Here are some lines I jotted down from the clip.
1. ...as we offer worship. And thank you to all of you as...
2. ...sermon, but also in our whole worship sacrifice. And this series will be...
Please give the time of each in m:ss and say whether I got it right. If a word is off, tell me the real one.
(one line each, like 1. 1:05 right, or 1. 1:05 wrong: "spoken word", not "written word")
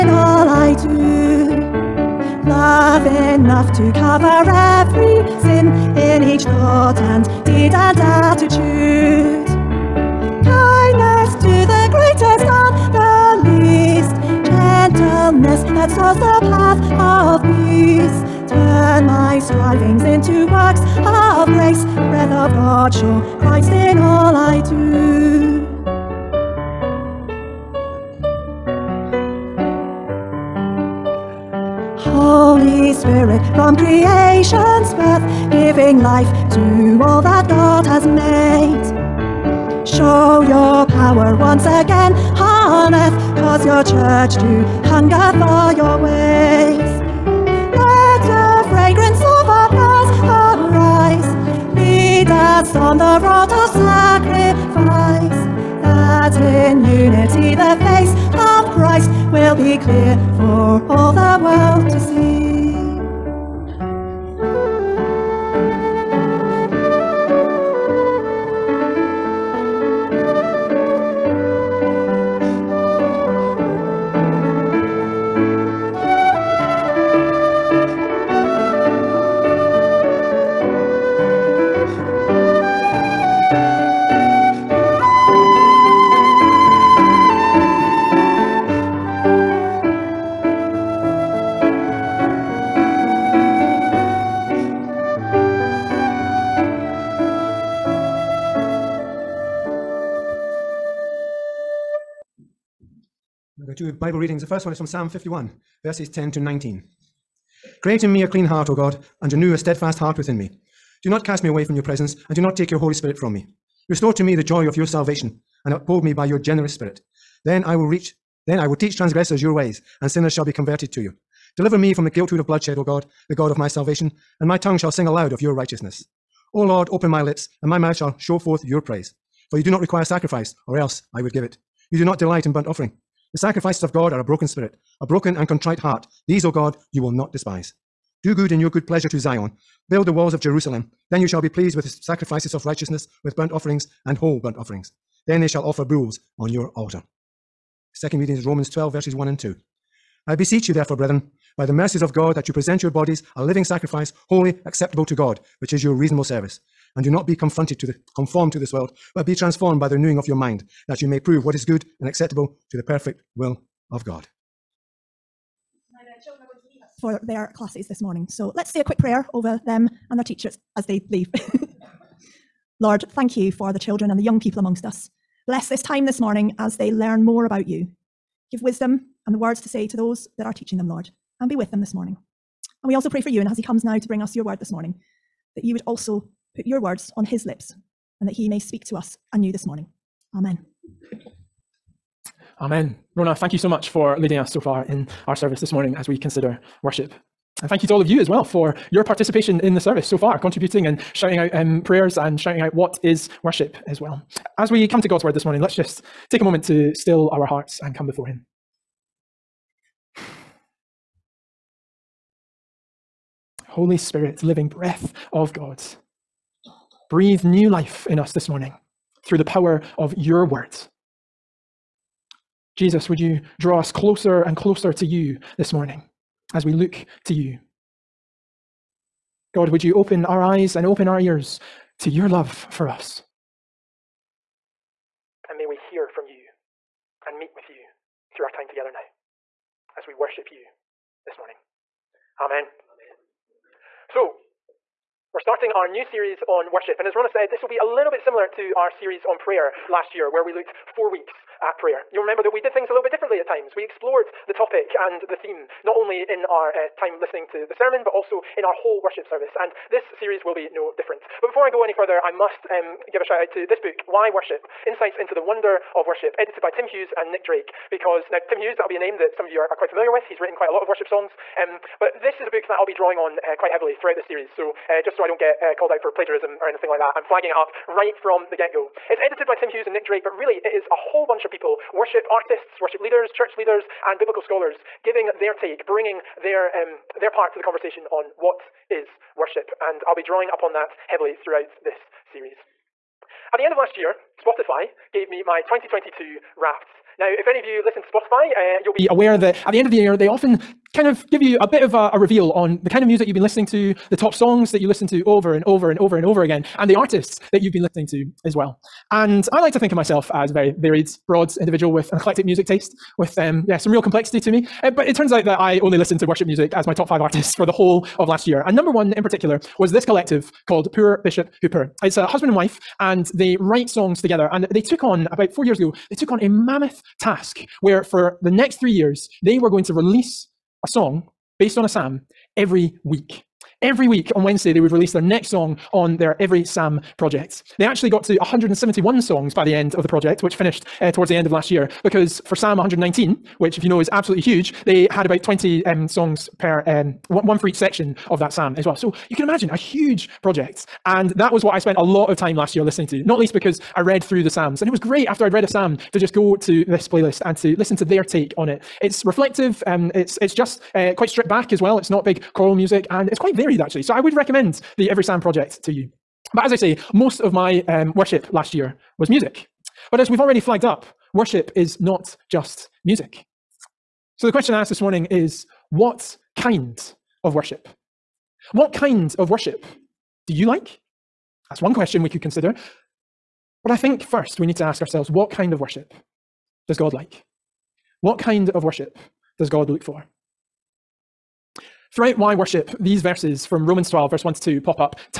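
1. 3:15 wrong: "consider", not "offer"
2. 4:17 wrong: "service", not "sacrifice".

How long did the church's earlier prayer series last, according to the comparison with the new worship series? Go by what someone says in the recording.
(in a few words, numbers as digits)
4 weeks.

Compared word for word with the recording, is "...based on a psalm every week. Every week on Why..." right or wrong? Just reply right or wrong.
wrong.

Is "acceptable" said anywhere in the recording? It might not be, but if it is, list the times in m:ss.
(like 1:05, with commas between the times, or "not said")
2:34, 2:42.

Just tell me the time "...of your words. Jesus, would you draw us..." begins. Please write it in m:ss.
3:39.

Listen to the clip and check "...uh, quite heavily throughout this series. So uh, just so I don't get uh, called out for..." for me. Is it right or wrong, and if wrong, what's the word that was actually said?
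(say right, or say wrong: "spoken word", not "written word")
right.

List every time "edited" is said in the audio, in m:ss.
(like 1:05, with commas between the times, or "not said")
4:26, 4:39.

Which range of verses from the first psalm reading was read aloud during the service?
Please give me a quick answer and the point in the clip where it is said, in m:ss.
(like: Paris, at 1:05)
10 to 19, at 1:46.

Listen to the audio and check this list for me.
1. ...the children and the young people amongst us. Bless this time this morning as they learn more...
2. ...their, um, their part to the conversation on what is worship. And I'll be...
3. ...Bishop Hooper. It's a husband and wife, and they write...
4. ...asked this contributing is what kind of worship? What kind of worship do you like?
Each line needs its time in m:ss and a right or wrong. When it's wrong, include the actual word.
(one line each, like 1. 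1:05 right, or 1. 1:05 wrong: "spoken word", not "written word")
1. 2:53 right
2. 4:46 right
3. 5:21 right
4. 6:14 wrong: "morning", not "contributing".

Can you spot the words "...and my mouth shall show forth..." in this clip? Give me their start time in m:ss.
2:07.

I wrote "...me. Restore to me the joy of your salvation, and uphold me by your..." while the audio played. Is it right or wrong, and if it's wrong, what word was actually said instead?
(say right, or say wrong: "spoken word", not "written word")
right.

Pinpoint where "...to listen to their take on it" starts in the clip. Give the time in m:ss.
5:57.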